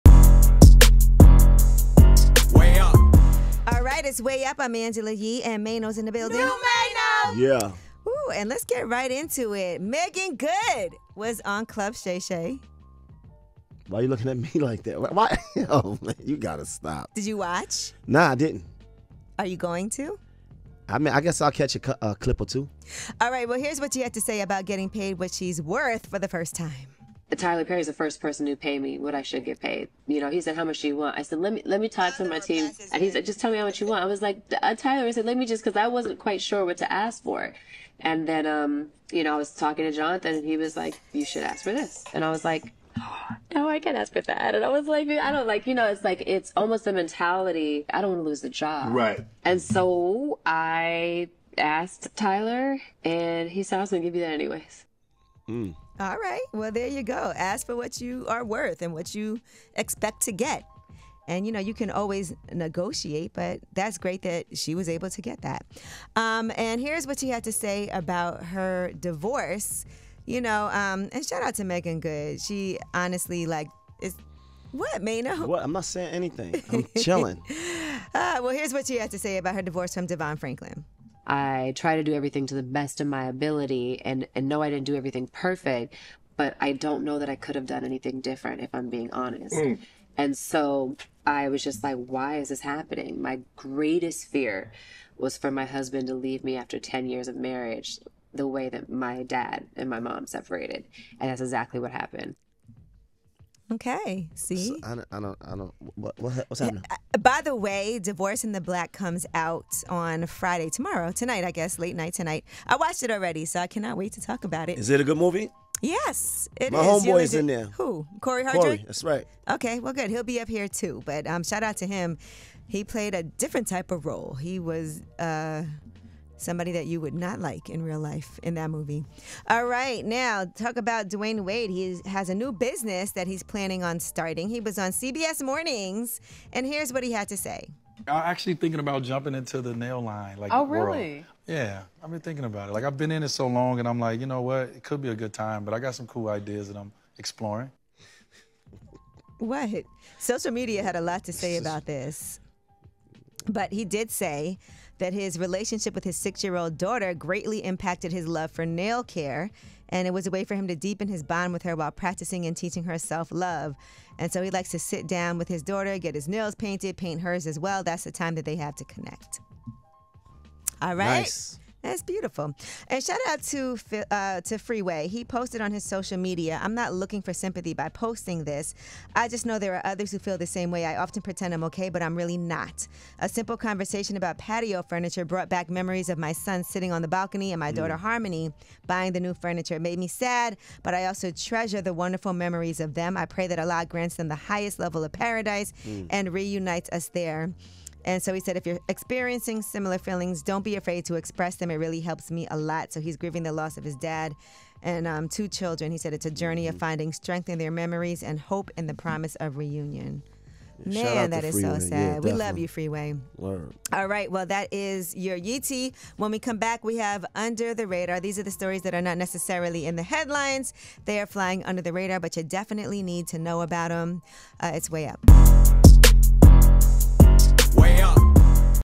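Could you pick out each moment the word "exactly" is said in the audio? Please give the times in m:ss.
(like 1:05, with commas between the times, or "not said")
1:41.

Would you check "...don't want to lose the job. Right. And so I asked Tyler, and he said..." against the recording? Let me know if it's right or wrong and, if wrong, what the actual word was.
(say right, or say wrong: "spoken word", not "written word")
right.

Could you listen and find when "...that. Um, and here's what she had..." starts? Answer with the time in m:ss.
1:05.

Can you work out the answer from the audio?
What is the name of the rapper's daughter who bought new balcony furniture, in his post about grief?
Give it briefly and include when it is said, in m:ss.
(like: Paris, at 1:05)
Harmony, at 3:07.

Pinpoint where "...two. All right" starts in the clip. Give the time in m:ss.
0:22.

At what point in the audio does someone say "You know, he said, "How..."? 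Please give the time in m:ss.
0:30.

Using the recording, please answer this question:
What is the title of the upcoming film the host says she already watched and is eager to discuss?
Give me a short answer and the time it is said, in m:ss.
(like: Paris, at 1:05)
Divorce in the Black, at 1:47.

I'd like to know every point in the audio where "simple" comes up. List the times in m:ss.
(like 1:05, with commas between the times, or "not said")
3:03.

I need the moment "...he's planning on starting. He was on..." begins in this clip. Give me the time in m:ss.
2:13.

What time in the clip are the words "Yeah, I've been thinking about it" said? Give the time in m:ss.
2:21.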